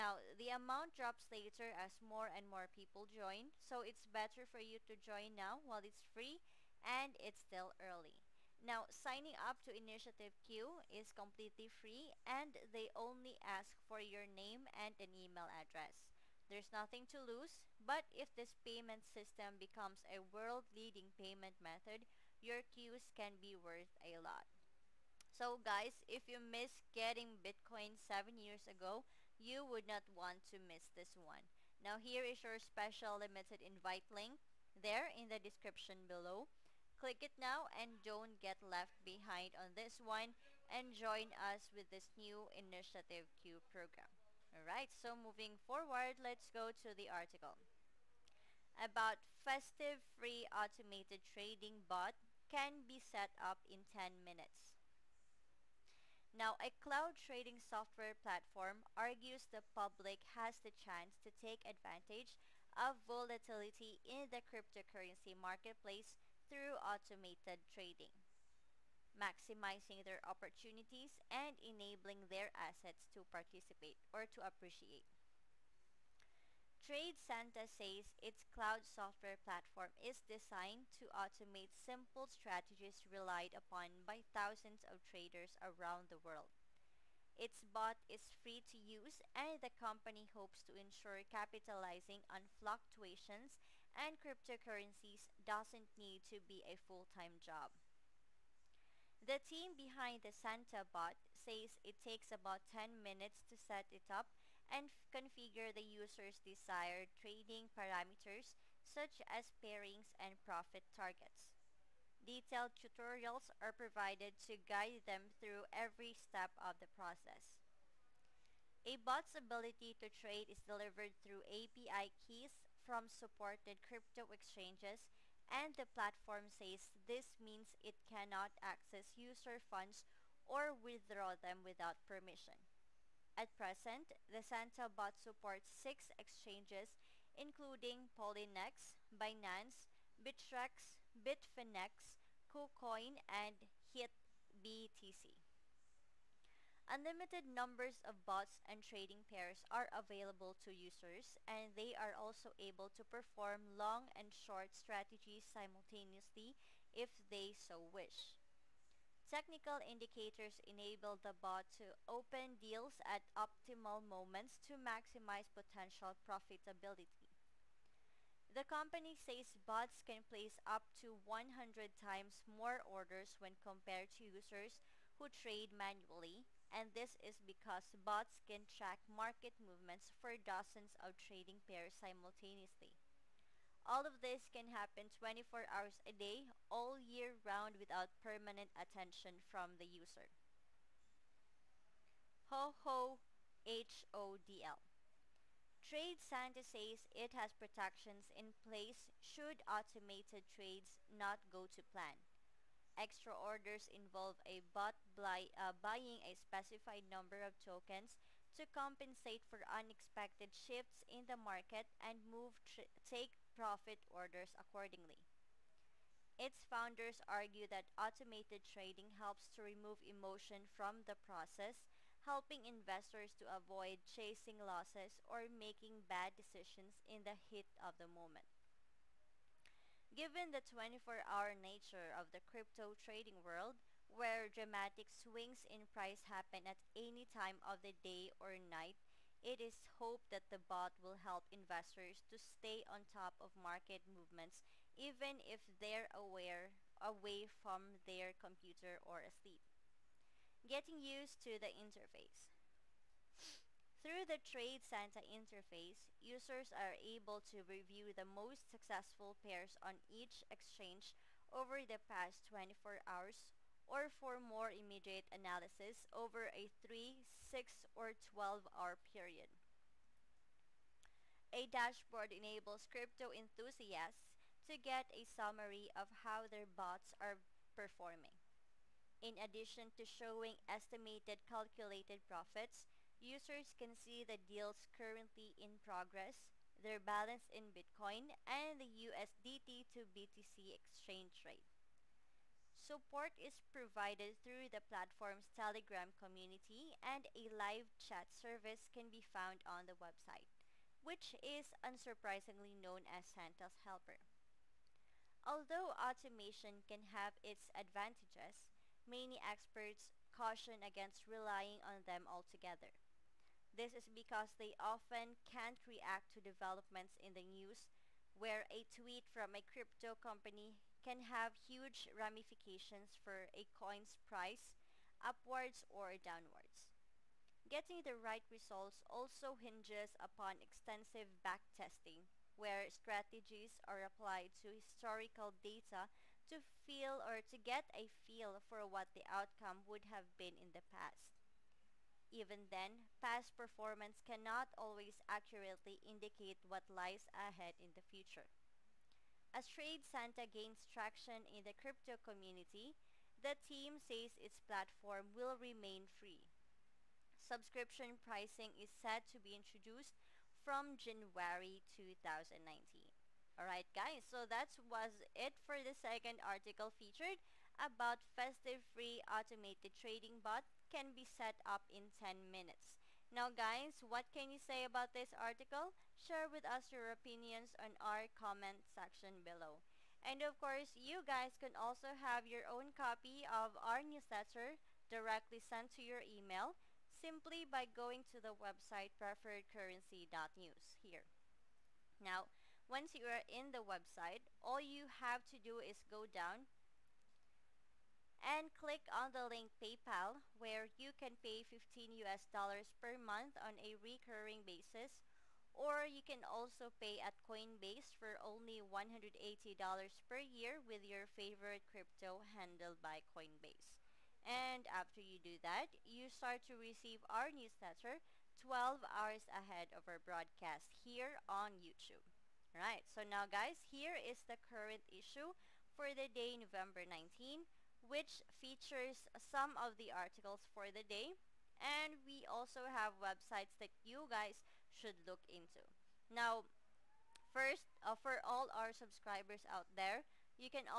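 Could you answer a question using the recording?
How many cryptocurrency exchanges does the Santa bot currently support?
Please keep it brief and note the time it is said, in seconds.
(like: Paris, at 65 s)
6, at 135 s.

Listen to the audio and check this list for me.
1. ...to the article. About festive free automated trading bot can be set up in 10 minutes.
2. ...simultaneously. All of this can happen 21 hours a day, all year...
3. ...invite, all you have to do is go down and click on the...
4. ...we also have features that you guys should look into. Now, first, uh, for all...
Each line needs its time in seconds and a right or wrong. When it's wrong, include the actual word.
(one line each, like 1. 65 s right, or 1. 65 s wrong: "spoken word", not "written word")
1. 46 s right
2. 181 s wrong: "24", not "21"
3. 393 s wrong: "website", not "invite"
4. 432 s wrong: "websites", not "features".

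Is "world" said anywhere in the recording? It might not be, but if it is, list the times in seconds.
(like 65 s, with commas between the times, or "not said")
20 s, 86 s, 233 s.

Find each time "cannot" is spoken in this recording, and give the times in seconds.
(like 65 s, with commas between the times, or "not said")
128 s, 344 s.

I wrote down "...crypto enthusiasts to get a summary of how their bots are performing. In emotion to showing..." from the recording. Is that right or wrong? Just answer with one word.
wrong.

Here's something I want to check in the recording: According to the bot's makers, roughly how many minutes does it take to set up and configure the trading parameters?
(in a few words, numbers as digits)
10.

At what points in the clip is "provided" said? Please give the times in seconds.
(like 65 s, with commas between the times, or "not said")
113 s, 293 s.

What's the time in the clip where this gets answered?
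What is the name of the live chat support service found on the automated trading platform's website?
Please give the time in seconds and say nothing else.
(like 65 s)
303 s.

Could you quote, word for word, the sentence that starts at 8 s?
Now, signing up to Initiative Q is completely free and they only ask for your name and an email address.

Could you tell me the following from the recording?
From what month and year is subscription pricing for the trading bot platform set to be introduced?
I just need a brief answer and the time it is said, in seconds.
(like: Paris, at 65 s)
January 2019, at 360 s.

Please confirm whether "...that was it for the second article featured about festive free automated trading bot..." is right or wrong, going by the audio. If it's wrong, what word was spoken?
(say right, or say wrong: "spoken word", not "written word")
right.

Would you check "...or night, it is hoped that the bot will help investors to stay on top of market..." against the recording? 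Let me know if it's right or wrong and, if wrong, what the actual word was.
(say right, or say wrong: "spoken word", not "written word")
right.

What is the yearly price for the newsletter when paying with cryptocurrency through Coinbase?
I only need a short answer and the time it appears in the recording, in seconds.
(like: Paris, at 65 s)
$180, at 408 s.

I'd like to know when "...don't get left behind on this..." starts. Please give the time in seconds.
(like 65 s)
38 s.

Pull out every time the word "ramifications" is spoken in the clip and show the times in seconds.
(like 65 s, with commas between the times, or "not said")
322 s.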